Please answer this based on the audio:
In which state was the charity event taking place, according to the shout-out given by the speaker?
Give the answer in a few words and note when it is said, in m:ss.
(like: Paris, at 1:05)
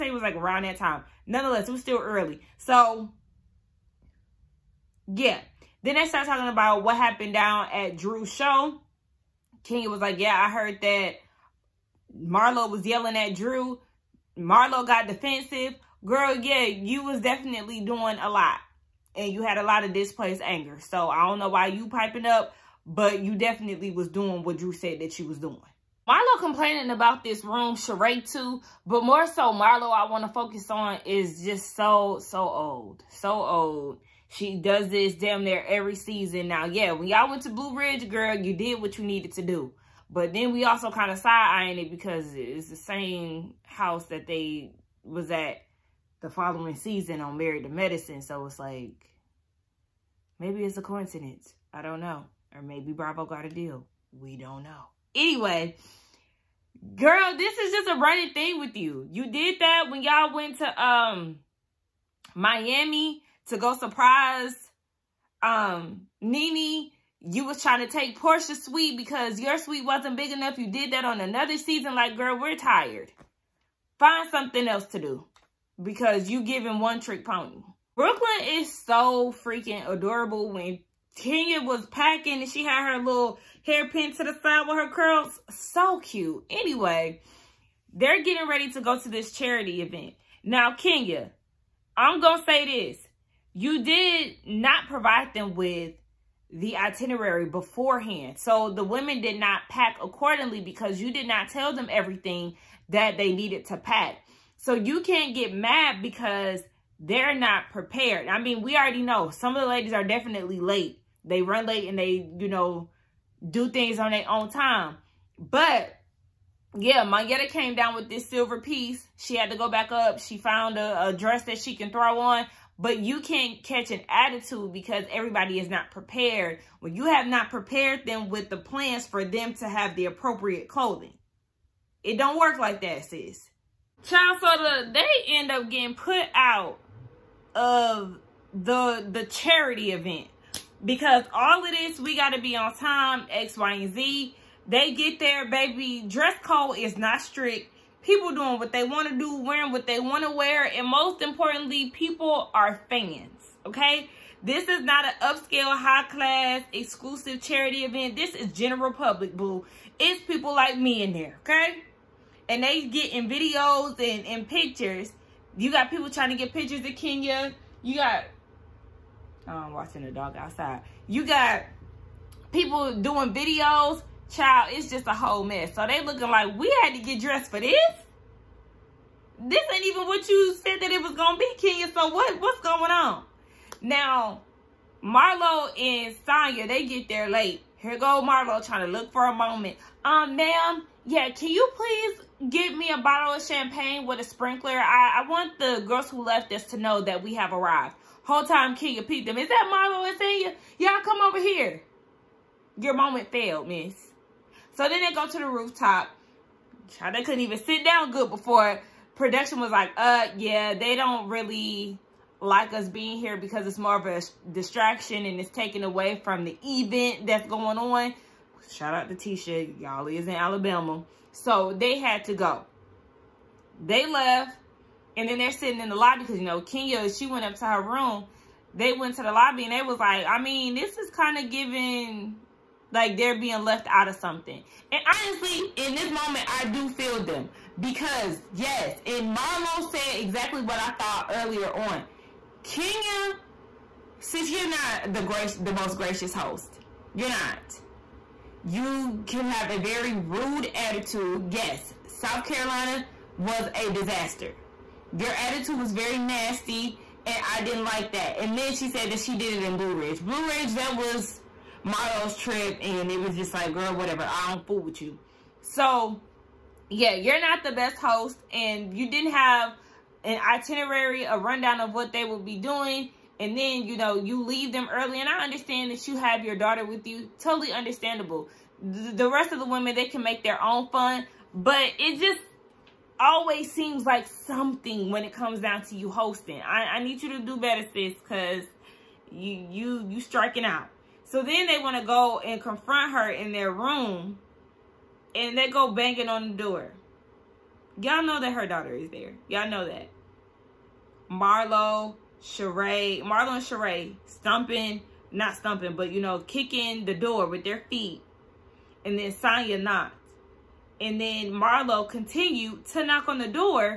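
Alabama, at 3:40.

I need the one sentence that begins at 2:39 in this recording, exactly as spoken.
It's people like me in there, okay?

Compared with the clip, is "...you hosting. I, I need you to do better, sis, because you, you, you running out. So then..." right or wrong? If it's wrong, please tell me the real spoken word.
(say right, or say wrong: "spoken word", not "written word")
wrong: "striking", not "running".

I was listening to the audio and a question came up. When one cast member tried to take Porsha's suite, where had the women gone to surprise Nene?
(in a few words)
Miami.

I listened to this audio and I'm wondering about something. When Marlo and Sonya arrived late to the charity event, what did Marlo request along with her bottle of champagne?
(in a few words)
A sprinkler.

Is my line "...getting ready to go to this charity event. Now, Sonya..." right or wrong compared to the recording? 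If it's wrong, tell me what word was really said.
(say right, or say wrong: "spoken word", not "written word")
wrong: "Kenya", not "Sonya".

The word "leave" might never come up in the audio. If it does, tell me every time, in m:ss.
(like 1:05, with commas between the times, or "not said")
4:34.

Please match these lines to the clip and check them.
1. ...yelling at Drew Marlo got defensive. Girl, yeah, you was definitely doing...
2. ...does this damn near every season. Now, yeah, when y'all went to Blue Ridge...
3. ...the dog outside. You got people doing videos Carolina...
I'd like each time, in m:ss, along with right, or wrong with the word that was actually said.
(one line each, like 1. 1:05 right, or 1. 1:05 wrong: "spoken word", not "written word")
1. 0:12 right
2. 0:34 right
3. 2:50 wrong: "Child", not "Carolina".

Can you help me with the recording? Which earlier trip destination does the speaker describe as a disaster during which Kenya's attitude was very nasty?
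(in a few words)
South Carolina.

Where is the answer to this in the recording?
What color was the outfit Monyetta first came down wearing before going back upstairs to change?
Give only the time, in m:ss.
1:58.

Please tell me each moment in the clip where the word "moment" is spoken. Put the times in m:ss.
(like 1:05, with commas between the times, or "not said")
3:09, 3:22, 3:56.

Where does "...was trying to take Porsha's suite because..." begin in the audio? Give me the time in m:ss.
1:07.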